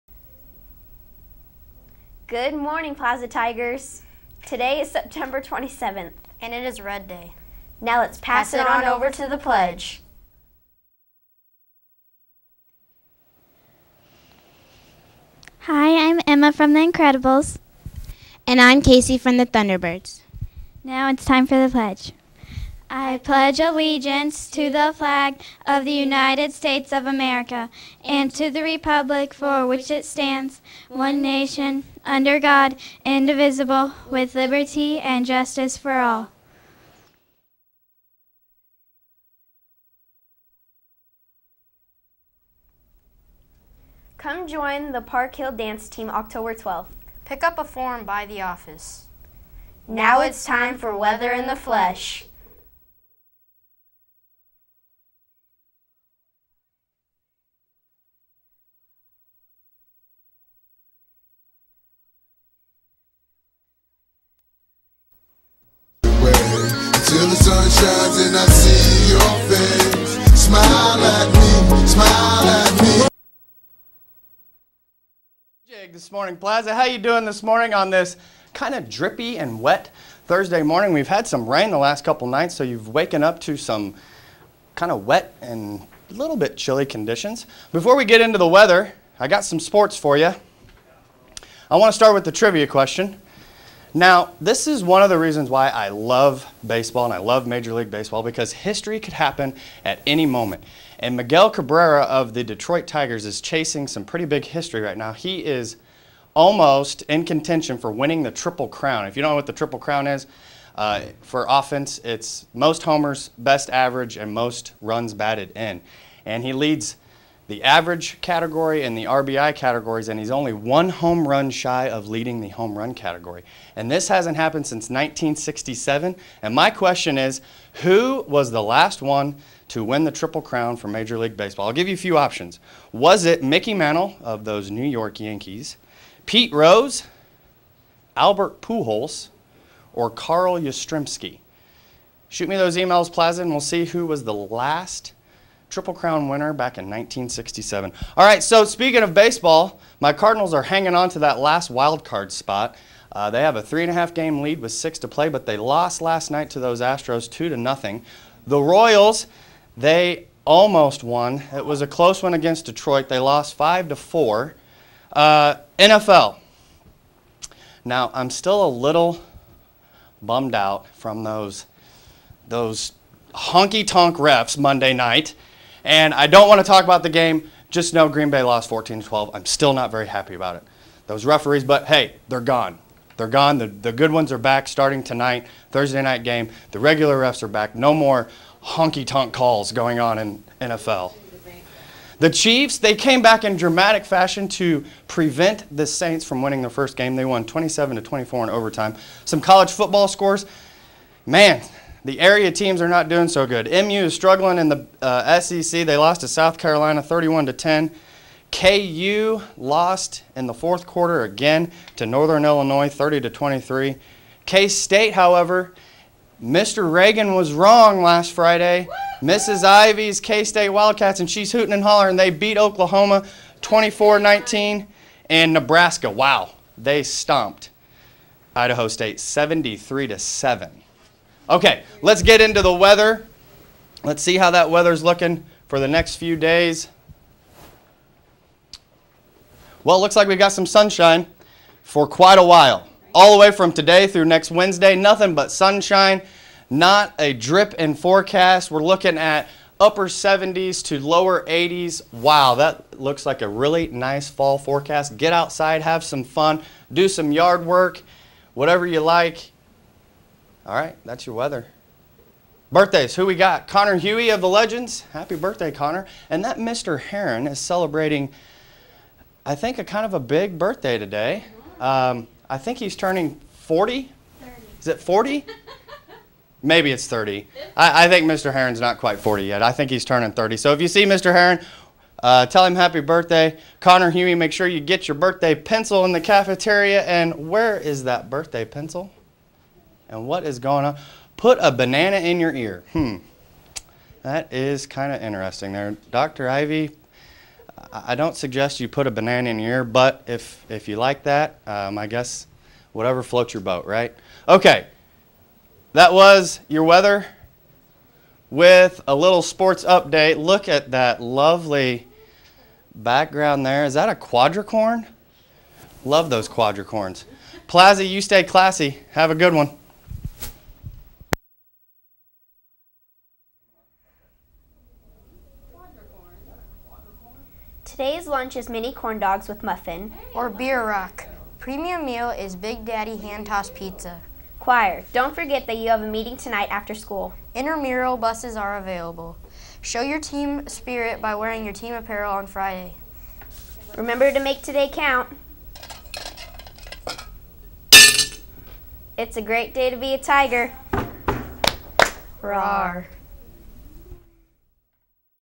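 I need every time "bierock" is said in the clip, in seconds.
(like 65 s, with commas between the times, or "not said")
330 s.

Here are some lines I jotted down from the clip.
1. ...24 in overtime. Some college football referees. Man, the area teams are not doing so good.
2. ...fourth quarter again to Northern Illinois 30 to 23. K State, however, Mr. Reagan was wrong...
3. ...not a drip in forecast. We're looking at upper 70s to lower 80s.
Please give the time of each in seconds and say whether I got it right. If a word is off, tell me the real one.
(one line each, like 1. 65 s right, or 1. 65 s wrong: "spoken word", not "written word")
1. 198 s wrong: "scores", not "referees"
2. 210 s right
3. 246 s right.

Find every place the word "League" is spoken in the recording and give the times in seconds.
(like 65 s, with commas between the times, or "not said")
97 s, 131 s.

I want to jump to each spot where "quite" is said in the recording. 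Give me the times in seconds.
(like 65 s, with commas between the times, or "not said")
242 s, 278 s.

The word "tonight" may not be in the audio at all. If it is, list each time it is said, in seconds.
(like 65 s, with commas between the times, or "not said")
185 s, 336 s.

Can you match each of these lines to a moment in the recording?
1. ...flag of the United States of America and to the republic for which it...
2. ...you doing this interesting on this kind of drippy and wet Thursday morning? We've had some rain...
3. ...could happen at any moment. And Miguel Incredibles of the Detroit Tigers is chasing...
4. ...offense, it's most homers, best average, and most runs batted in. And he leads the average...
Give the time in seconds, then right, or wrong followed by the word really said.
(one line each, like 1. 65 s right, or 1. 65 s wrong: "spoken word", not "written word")
1. 24 s right
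2. 76 s wrong: "morning", not "interesting"
3. 99 s wrong: "Cabrera", not "Incredibles"
4. 111 s right.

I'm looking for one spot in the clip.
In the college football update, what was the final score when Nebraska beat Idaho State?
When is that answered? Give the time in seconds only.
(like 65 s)
229 s.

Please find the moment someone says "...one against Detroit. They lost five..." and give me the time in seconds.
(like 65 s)
162 s.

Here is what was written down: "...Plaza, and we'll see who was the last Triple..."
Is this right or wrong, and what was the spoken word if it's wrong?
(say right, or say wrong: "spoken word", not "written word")
right.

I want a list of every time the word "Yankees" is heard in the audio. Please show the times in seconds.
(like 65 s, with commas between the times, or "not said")
135 s.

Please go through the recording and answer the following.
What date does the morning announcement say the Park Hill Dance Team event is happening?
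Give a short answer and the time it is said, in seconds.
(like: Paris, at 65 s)
October 12th, at 46 s.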